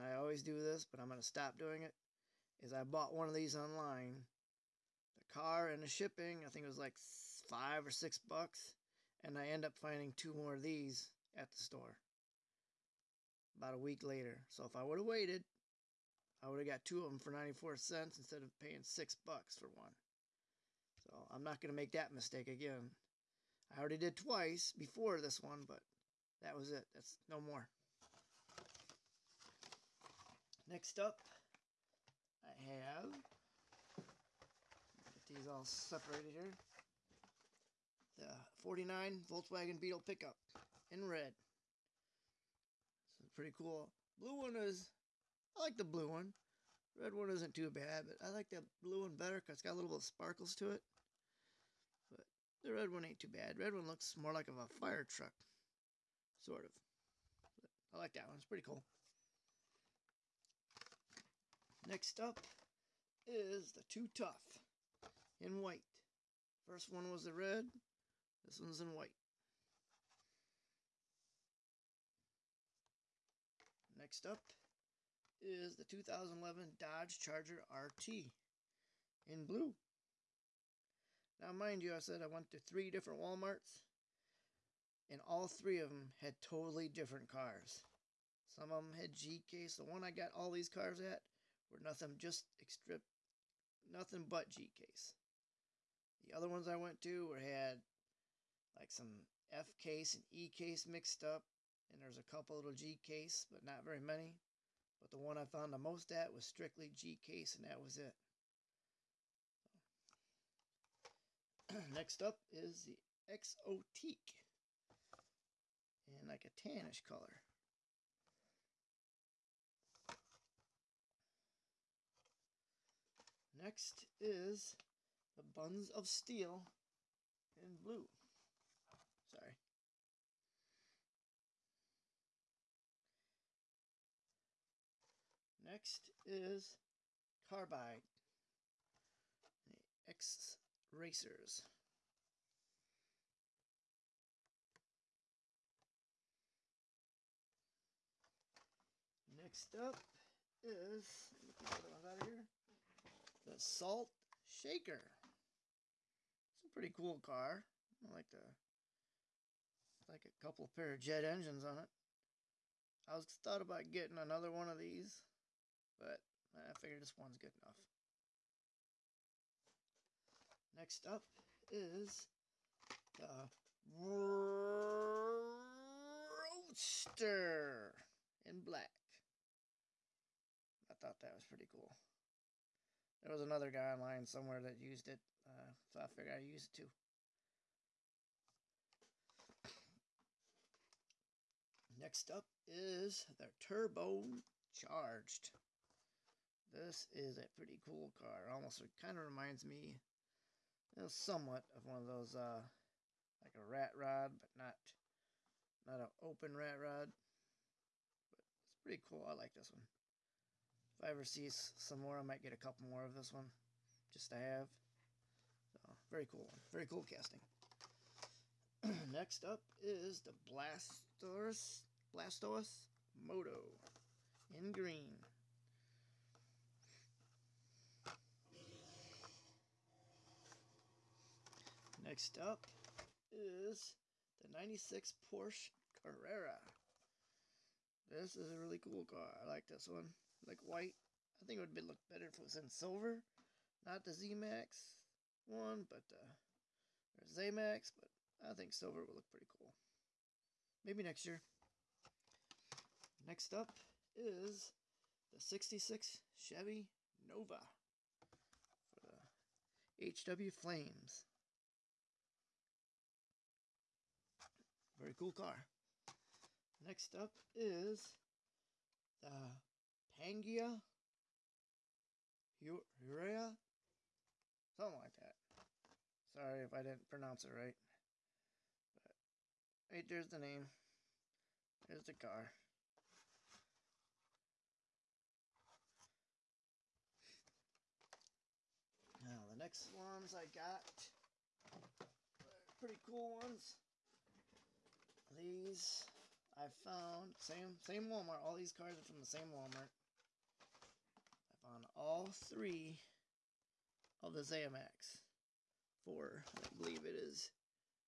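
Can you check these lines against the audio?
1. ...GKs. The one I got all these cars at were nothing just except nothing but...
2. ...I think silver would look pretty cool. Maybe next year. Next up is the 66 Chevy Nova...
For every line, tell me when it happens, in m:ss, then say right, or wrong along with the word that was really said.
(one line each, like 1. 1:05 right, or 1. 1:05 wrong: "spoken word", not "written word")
1. 1:29 right
2. 4:08 right.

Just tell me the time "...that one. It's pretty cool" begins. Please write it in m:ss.
0:58.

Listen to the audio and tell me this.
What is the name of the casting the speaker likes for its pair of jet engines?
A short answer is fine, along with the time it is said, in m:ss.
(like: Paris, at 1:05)
Salt Shaker, at 2:33.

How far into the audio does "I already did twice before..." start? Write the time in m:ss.
0:23.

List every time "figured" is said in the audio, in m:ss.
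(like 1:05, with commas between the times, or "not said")
2:46, 3:06.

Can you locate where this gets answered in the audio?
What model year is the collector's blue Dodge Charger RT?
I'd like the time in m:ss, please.
1:15.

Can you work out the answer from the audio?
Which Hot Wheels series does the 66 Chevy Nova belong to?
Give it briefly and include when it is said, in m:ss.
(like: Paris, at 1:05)
HW Flames, at 4:20.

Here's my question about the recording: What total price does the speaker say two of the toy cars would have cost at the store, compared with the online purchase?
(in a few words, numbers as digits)
94 cents.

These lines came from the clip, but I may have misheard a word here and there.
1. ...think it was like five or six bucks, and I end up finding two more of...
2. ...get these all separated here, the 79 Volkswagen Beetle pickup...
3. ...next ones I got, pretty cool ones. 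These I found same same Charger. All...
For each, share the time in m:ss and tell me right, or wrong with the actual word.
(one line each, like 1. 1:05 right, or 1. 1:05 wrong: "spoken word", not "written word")
1. 0:06 right
2. 0:35 wrong: "49", not "79"
3. 4:49 wrong: "Walmart", not "Charger".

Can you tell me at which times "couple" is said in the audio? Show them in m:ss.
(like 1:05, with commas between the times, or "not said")
1:42, 2:40, 3:32.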